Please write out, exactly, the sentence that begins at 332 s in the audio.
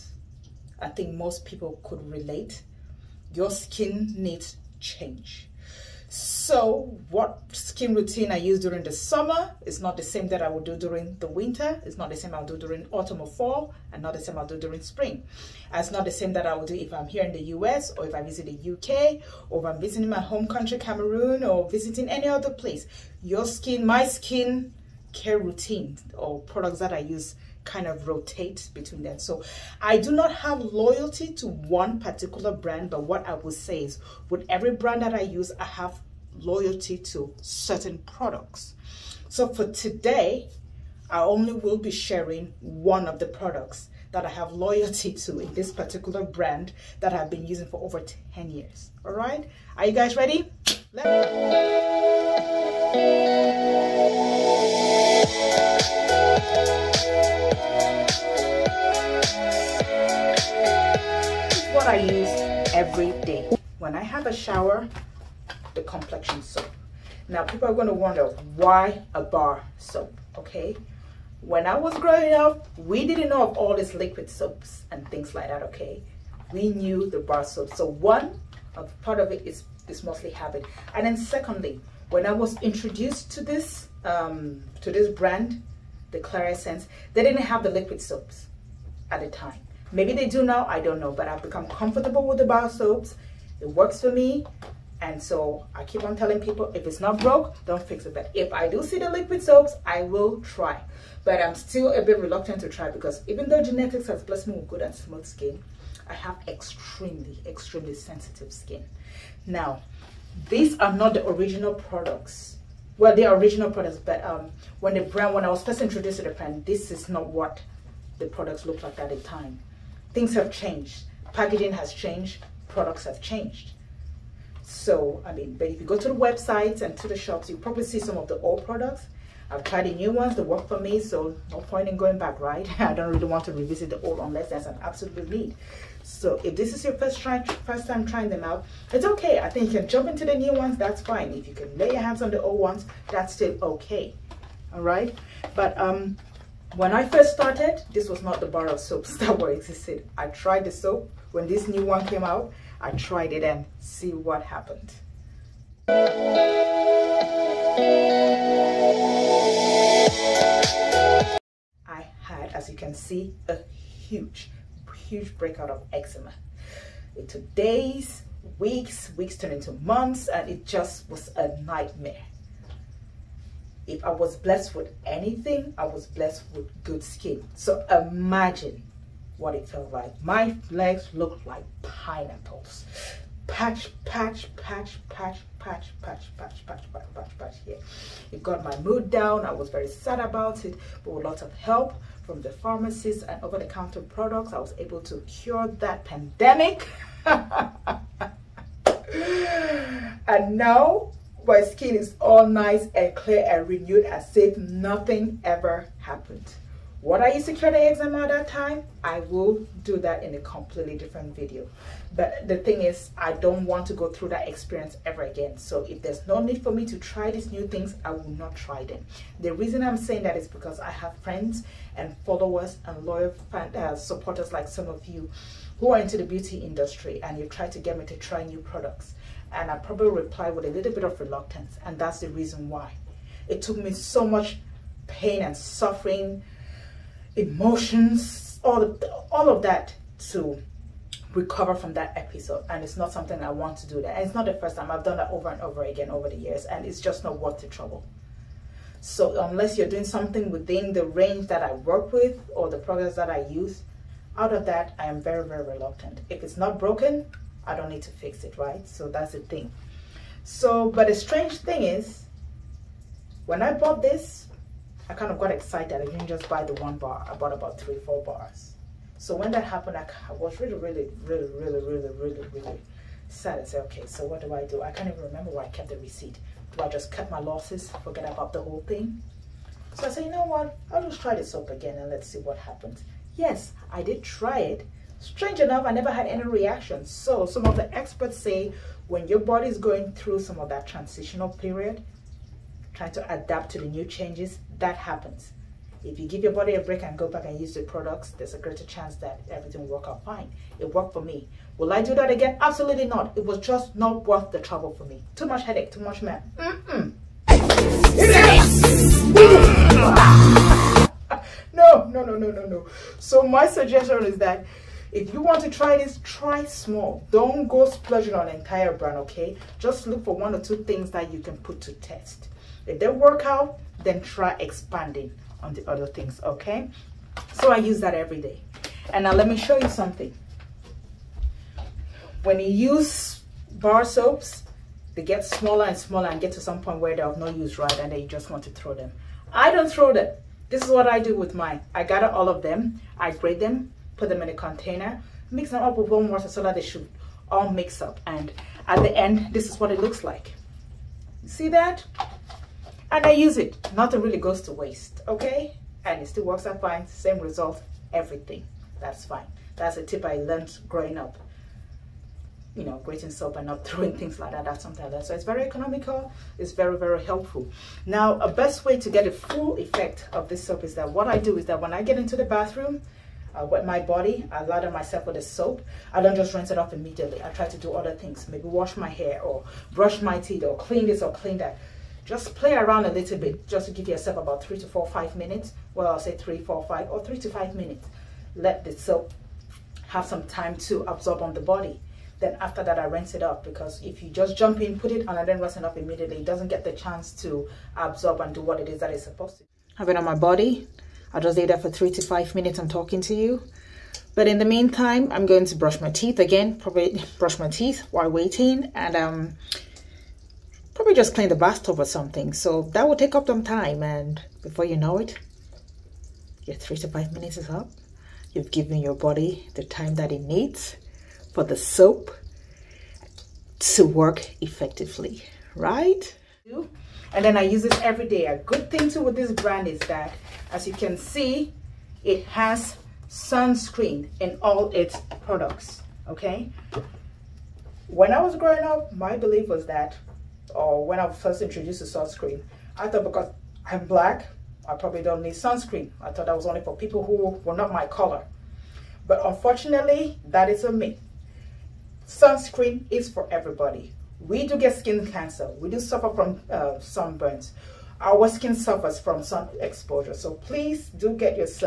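When you use bar soaps, they get smaller and smaller and get to some point where they're of no use, right?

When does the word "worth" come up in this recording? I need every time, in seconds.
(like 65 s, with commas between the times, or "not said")
247 s, 304 s.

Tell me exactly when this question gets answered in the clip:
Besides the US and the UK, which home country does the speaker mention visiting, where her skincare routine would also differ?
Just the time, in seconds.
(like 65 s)
20 s.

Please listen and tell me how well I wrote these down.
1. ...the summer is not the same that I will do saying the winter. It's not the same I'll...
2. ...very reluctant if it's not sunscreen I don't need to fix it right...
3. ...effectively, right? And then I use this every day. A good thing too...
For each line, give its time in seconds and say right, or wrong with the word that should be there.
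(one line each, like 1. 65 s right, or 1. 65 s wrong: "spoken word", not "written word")
1. 8 s wrong: "during", not "saying"
2. 255 s wrong: "broken", not "sunscreen"
3. 424 s right.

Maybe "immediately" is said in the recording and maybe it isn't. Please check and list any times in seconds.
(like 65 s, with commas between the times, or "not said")
376 s, 395 s.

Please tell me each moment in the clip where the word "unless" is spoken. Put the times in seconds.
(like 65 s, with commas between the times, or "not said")
134 s, 249 s.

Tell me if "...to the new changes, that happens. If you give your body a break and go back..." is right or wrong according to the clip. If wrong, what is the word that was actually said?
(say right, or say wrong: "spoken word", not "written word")
right.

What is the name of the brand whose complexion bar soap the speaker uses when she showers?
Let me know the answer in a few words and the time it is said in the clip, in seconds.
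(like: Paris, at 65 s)
Clear Essence, at 86 s.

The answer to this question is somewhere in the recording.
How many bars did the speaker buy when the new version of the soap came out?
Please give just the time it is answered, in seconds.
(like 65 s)
267 s.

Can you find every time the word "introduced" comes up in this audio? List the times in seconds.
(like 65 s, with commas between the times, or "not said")
82 s, 115 s, 441 s.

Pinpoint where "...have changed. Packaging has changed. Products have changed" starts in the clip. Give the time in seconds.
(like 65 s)
120 s.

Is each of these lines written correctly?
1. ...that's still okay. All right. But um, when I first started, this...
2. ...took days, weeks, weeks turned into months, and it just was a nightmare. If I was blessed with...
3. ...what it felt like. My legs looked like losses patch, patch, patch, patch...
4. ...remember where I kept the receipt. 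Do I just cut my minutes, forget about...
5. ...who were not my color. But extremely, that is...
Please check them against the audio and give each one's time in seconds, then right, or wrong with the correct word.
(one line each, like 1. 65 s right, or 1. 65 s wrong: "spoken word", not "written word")
1. 143 s right
2. 167 s right
3. 179 s wrong: "pineapples", not "losses"
4. 275 s wrong: "losses", not "minutes"
5. 447 s wrong: "unfortunately", not "extremely".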